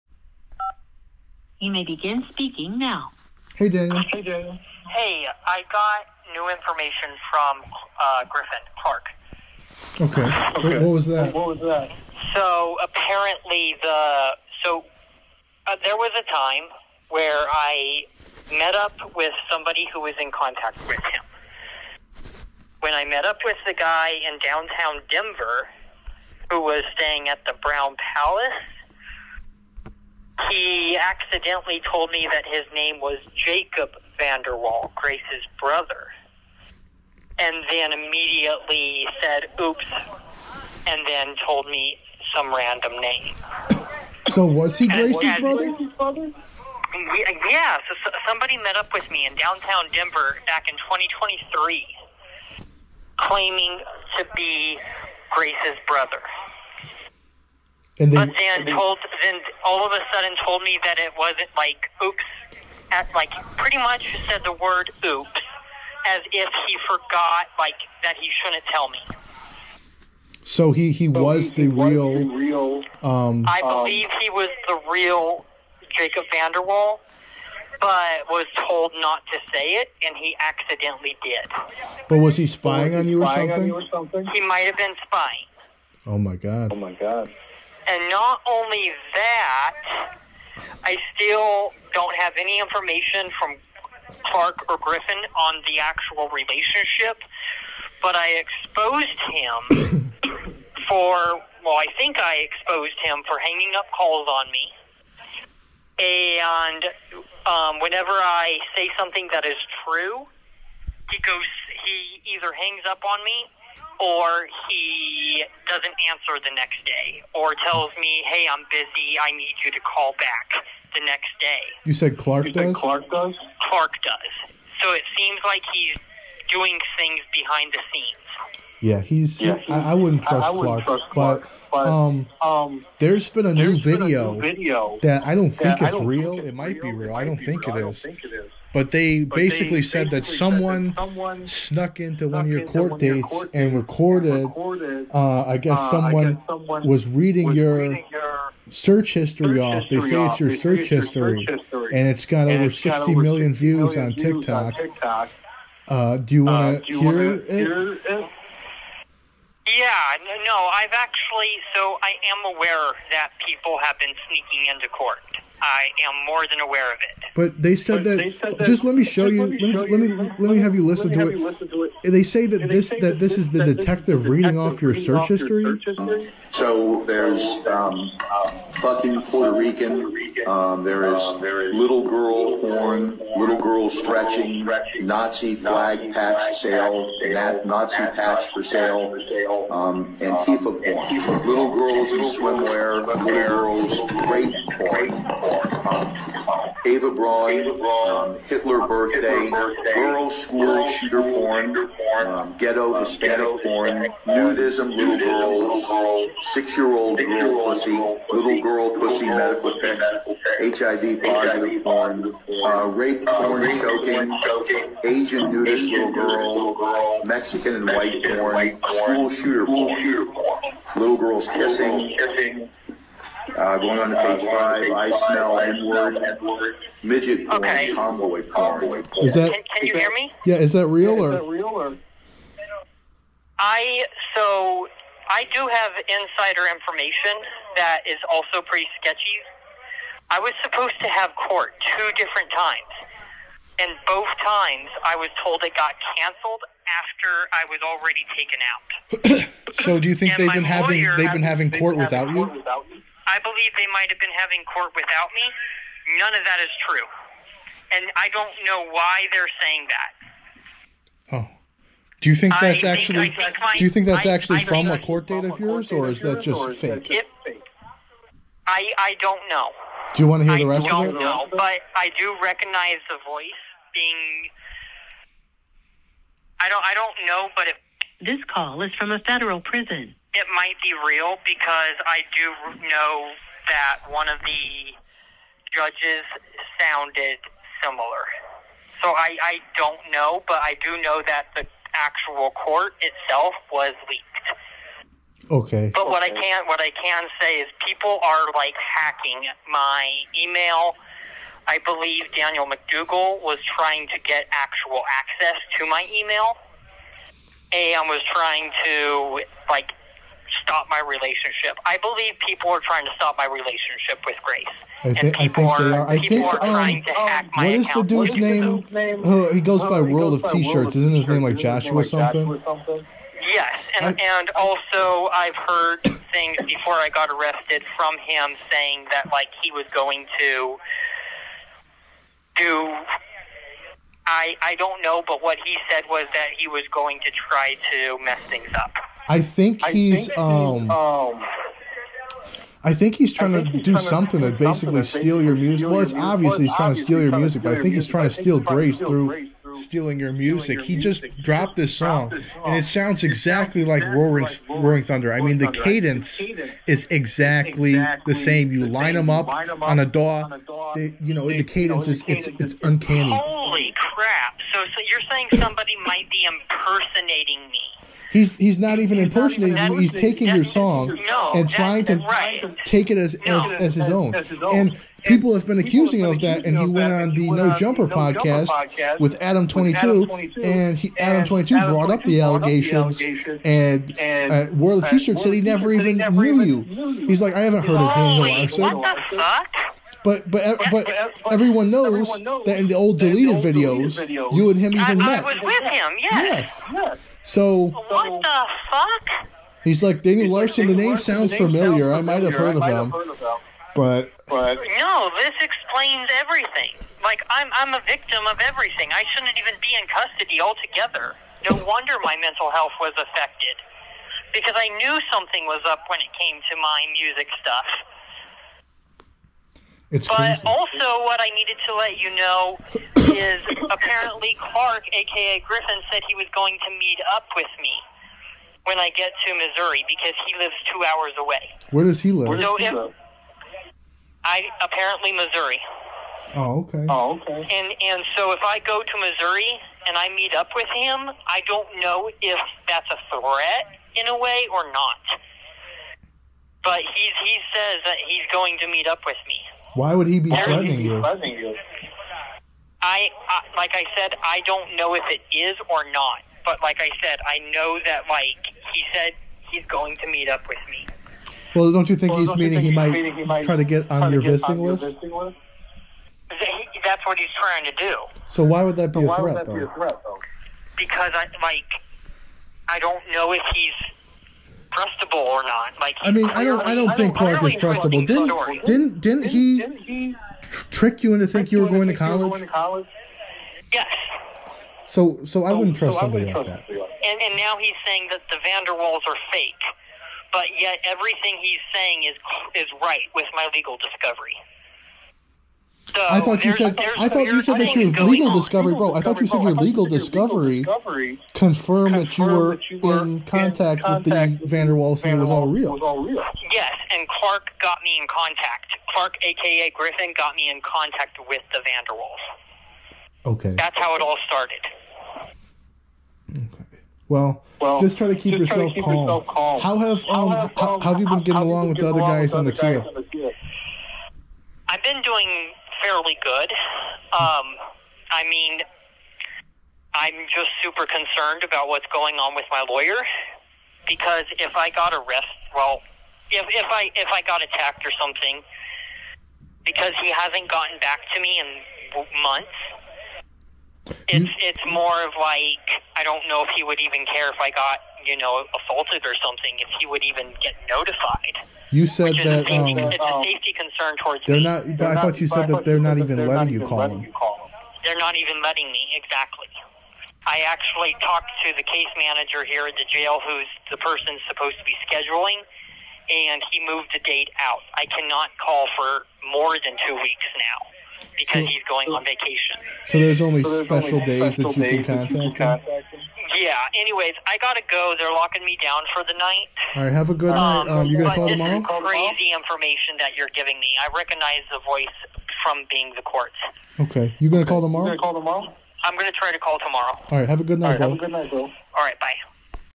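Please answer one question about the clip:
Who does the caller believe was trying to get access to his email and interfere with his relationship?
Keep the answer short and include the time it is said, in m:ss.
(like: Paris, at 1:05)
Daniel McDougal, at 5:02.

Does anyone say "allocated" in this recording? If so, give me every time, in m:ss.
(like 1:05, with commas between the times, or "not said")
not said.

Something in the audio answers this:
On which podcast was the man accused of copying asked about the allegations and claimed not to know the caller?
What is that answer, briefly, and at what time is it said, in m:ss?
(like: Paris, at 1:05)
No Jumper, at 6:17.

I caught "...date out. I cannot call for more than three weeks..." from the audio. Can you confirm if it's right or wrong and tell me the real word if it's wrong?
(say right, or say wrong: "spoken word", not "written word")
wrong: "two", not "three".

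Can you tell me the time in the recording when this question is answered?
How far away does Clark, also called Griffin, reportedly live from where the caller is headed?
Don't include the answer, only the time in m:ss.
7:10.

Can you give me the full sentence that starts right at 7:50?
Because I like I don't know if he's trustable or not.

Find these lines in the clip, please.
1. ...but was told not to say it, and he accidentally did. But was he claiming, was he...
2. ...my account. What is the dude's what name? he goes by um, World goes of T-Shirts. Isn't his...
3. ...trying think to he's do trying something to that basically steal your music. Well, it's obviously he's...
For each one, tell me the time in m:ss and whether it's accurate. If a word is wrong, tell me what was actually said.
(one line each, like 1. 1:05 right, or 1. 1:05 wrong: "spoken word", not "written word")
1. 1:17 wrong: "spying", not "claiming"
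2. 5:17 right
3. 5:43 right.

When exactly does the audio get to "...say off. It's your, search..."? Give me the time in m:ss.
2:30.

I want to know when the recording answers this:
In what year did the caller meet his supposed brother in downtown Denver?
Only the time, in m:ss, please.
0:50.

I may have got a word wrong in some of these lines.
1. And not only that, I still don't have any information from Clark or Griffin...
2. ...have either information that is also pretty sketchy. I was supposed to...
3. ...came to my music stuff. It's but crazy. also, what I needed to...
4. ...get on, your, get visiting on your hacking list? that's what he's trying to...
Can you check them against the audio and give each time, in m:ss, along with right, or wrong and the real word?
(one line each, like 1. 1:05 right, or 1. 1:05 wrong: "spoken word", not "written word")
1. 1:27 right
2. 3:55 wrong: "insider", not "either"
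3. 6:56 right
4. 7:43 wrong: "visiting", not "hacking".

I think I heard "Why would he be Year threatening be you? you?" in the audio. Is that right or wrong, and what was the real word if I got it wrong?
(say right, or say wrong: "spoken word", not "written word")
wrong: "Why", not "Year".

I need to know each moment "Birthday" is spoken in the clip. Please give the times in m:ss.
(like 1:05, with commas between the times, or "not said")
3:18.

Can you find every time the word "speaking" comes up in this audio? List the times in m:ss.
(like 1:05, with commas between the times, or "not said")
0:02.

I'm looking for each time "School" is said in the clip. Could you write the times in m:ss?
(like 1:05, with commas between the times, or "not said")
3:20, 3:39.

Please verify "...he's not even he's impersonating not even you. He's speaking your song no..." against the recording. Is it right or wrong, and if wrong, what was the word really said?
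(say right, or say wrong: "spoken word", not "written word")
wrong: "taking", not "speaking".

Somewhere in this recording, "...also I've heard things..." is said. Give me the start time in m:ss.
5:24.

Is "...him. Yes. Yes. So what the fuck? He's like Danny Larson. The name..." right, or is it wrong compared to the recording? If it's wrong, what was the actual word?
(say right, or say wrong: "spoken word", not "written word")
right.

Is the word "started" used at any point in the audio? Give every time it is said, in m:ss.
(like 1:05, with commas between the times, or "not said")
8:34.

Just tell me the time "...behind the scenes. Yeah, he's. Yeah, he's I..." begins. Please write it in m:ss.
2:07.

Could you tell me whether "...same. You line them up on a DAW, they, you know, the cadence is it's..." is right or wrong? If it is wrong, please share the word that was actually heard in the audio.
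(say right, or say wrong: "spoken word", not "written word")
right.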